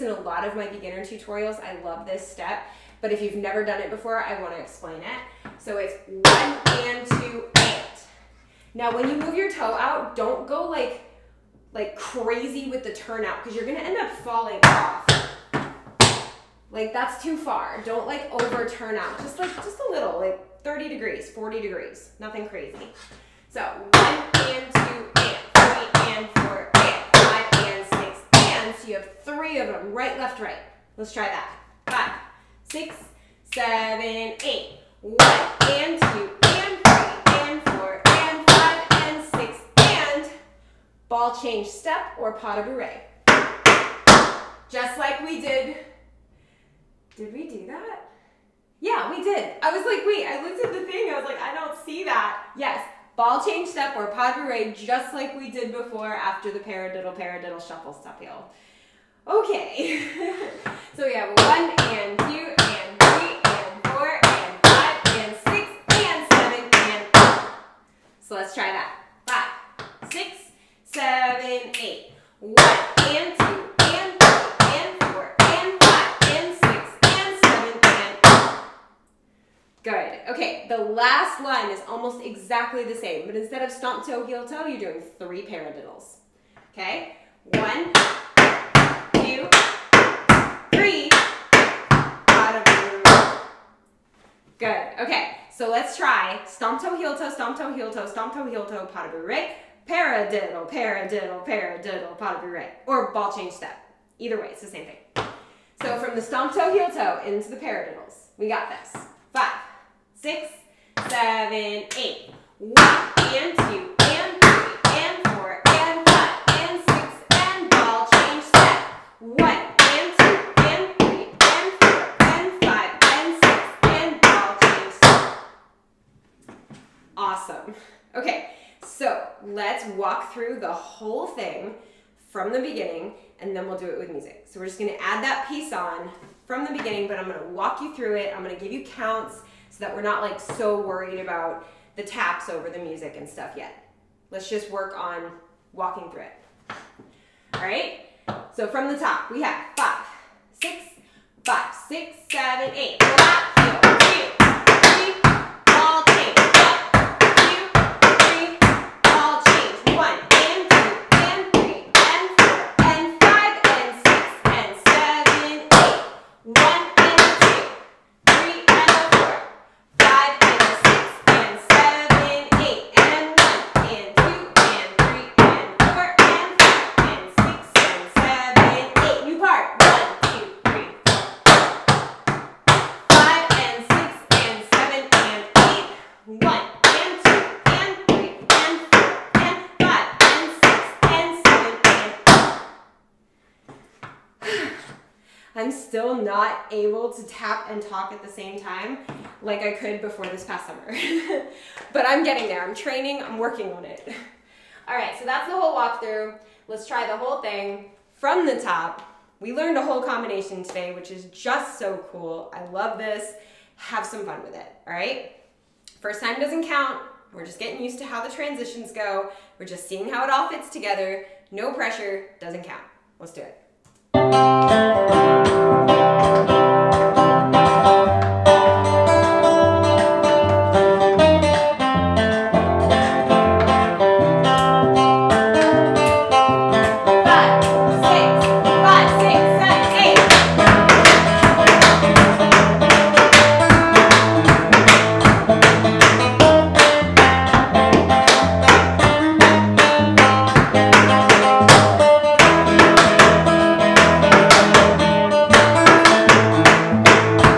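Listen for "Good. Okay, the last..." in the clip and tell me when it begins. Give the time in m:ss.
1:19.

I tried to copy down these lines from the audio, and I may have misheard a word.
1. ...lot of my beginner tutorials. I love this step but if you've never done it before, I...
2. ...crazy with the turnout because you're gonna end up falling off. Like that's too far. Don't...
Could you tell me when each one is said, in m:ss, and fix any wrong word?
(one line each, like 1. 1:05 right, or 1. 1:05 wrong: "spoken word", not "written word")
1. 0:00 right
2. 0:11 right.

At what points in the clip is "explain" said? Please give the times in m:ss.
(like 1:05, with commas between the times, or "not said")
0:04.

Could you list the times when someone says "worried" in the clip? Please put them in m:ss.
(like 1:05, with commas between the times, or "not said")
2:20.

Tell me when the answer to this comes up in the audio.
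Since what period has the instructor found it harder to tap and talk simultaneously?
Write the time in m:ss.
3:20.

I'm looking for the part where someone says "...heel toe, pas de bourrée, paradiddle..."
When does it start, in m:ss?
1:38.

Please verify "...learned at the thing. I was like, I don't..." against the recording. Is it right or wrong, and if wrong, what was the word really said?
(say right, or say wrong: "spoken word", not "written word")
wrong: "looked", not "learned".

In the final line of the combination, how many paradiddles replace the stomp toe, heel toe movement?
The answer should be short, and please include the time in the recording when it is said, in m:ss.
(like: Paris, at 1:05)
3, at 1:25.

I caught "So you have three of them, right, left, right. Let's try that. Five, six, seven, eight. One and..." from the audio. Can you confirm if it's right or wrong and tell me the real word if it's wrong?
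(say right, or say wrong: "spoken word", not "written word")
right.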